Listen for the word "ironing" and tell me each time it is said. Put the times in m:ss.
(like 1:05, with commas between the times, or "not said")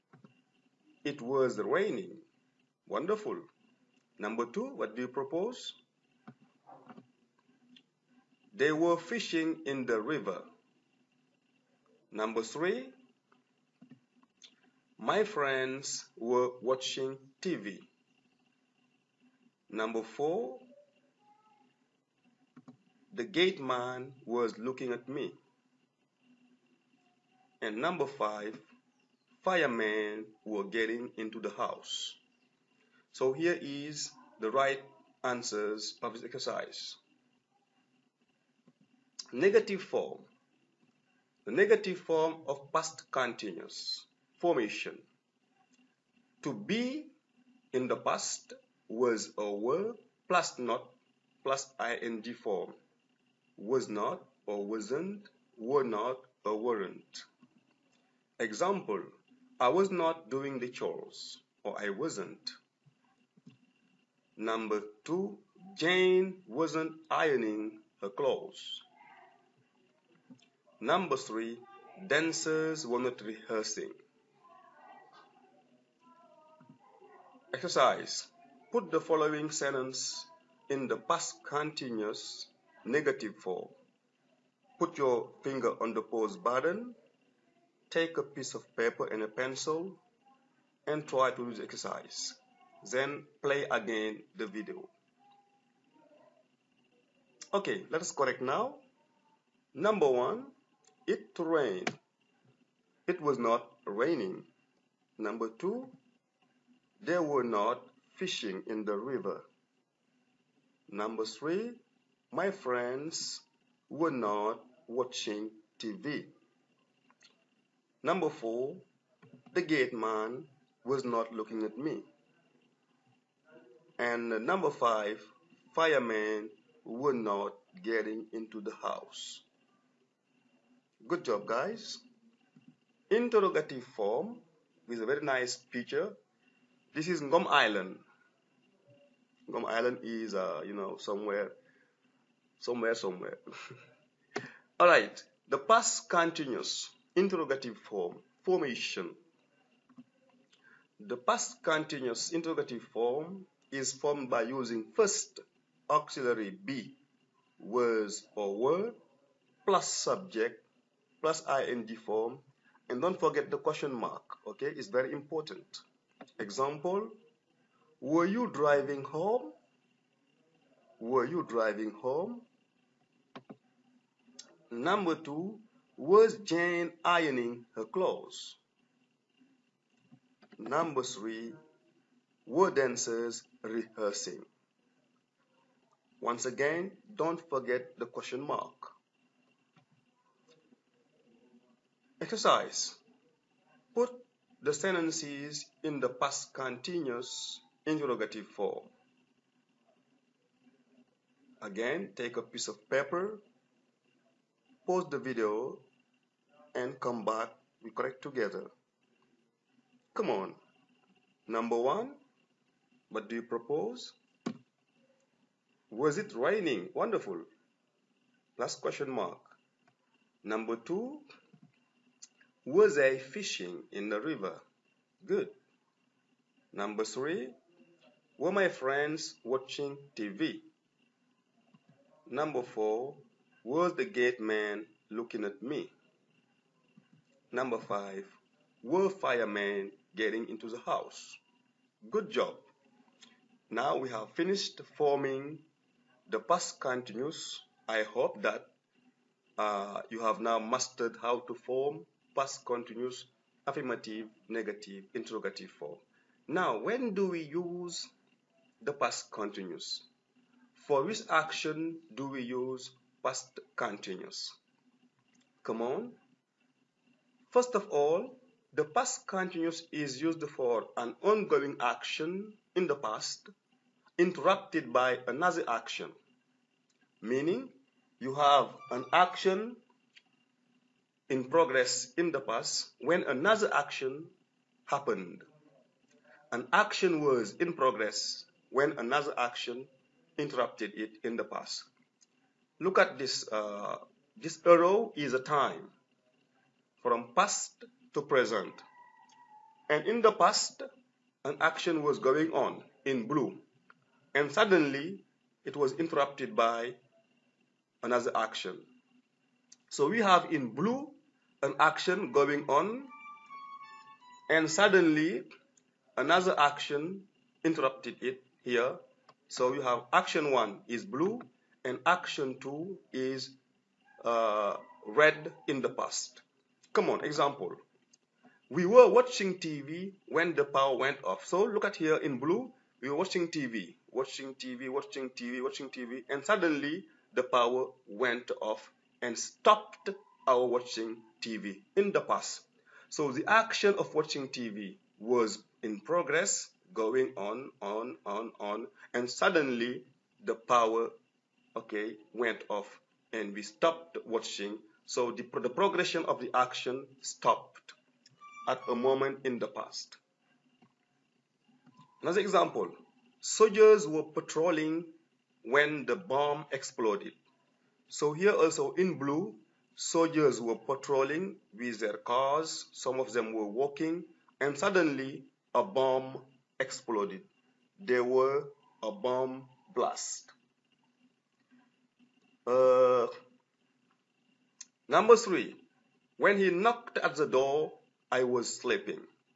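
1:07, 2:57.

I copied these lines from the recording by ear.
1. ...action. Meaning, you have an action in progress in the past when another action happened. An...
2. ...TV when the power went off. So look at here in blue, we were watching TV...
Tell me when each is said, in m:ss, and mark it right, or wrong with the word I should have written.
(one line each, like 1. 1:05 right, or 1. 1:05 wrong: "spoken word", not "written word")
1. 4:35 right
2. 5:29 right.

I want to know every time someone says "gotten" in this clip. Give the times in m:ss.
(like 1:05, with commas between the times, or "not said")
not said.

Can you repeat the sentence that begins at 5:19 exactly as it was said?
So you have action one is blue, and action two is uh, red in the past.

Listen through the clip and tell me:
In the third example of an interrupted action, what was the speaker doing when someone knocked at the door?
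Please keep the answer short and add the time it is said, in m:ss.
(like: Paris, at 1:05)
sleeping, at 6:28.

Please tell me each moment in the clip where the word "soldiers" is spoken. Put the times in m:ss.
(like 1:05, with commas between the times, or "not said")
6:03, 6:09.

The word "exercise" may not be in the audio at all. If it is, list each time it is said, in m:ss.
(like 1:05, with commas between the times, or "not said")
0:36, 1:17, 1:31, 3:12.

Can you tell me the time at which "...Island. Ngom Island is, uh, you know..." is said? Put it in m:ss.
2:17.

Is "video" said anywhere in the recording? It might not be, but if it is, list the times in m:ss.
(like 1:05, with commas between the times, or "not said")
1:34, 3:25.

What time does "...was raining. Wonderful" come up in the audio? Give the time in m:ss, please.
0:01.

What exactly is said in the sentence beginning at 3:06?
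Once again, don't forget the question mark.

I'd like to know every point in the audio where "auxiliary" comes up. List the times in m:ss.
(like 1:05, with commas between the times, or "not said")
2:35.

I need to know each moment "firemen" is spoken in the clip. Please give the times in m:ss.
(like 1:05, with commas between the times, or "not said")
0:29, 2:05, 3:59.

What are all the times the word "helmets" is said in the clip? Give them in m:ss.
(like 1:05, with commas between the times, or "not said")
not said.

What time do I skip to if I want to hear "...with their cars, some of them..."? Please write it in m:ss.
6:11.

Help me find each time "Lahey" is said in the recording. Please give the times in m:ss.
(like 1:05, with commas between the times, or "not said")
not said.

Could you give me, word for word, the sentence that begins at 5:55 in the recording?
So the, the progression of the action stopped at a moment in the past.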